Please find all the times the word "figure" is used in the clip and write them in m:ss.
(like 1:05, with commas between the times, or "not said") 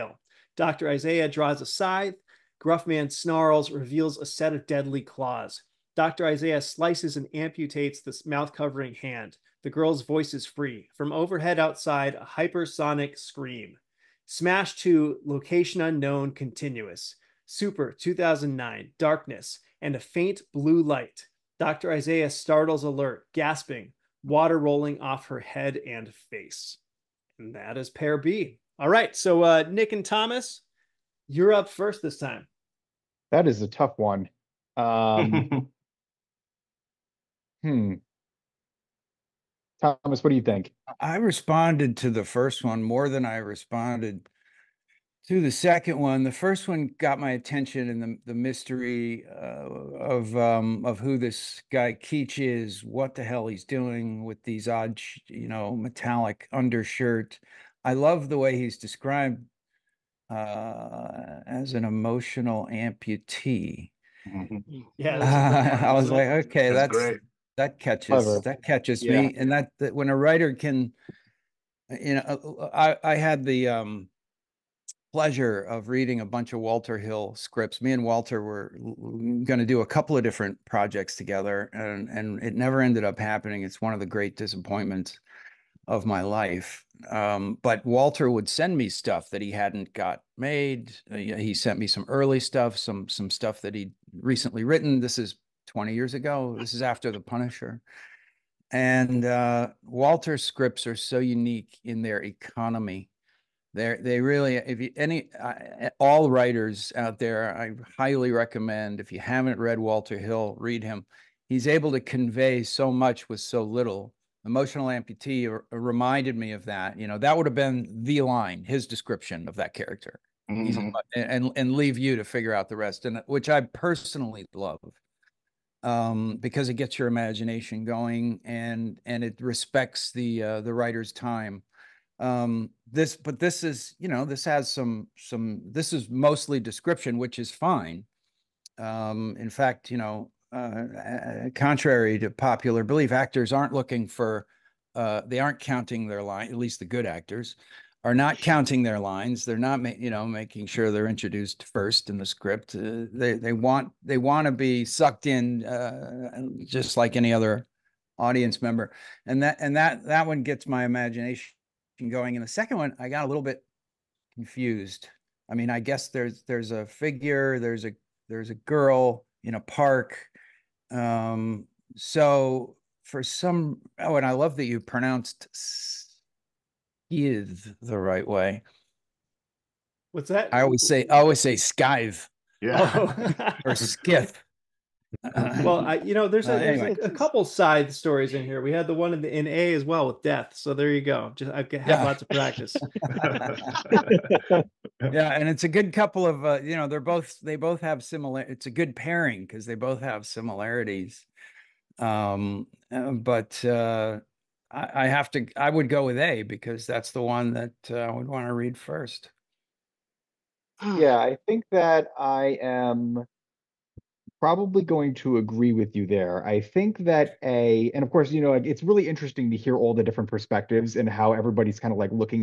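2:02, 2:46.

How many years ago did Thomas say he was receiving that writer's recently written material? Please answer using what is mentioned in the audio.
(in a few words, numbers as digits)
20.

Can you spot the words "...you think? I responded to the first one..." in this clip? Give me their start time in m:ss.
0:40.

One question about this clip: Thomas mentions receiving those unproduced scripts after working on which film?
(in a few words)
The Punisher.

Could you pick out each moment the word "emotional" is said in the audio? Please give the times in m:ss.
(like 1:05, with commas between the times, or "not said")
1:01, 1:54.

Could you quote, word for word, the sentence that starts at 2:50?
Um, so for some, oh, and I love that you pronounced skive the right way.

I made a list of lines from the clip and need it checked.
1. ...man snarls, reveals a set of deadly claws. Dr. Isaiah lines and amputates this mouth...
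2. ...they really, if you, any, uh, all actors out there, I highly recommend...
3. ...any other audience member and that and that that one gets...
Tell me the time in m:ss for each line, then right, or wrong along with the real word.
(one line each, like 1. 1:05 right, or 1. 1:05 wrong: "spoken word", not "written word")
1. 0:02 wrong: "slices", not "lines"
2. 1:43 wrong: "writers", not "actors"
3. 2:37 right.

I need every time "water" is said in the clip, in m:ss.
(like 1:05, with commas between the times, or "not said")
0:24.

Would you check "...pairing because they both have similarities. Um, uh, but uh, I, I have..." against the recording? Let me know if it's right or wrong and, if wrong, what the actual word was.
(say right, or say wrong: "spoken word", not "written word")
right.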